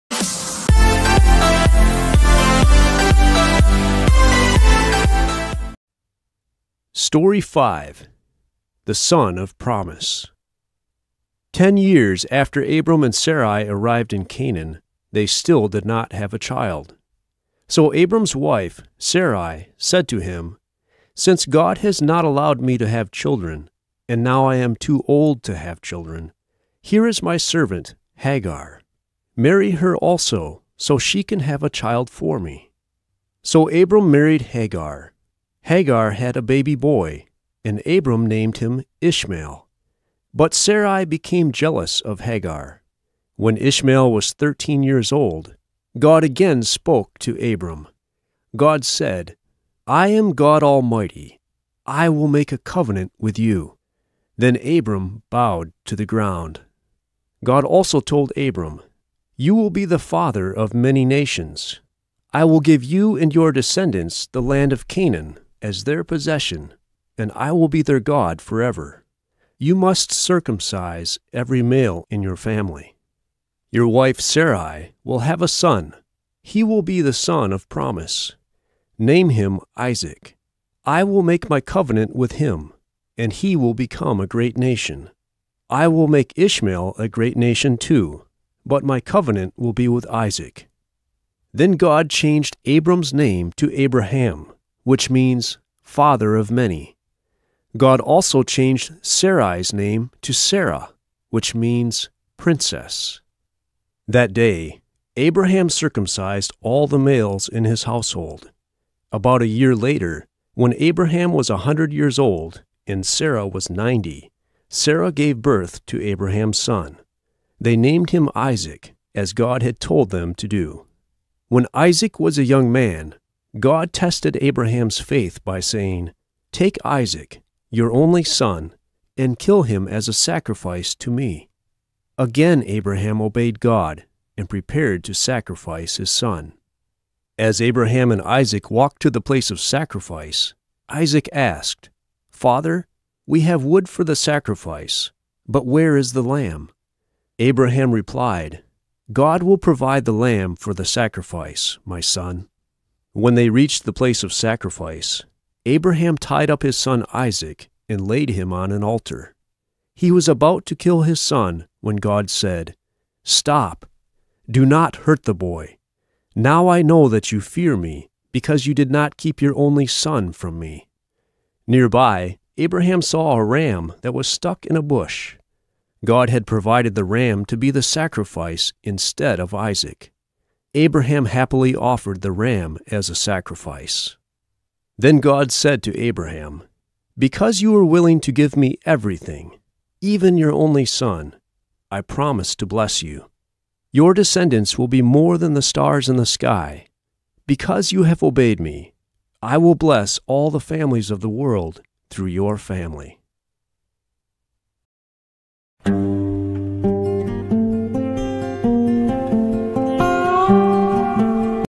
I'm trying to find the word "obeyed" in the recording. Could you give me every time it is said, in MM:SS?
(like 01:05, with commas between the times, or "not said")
02:13, 03:18.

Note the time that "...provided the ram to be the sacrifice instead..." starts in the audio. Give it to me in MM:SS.
02:56.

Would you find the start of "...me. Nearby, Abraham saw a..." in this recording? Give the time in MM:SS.
02:50.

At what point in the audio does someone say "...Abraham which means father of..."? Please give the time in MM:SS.
01:33.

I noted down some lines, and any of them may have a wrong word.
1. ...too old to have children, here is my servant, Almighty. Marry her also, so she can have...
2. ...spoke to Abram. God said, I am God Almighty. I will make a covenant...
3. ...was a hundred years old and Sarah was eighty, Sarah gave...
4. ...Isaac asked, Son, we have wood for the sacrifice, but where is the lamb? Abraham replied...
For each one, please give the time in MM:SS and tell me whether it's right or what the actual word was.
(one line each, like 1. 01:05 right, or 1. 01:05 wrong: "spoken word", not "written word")
1. 00:24 wrong: "Hagar", not "Almighty"
2. 00:46 right
3. 01:51 wrong: "ninety", not "eighty"
4. 02:20 wrong: "Father", not "Son".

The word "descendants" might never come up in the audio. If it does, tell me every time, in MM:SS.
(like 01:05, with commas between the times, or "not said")
01:03, 03:14.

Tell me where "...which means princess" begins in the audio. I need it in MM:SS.
01:41.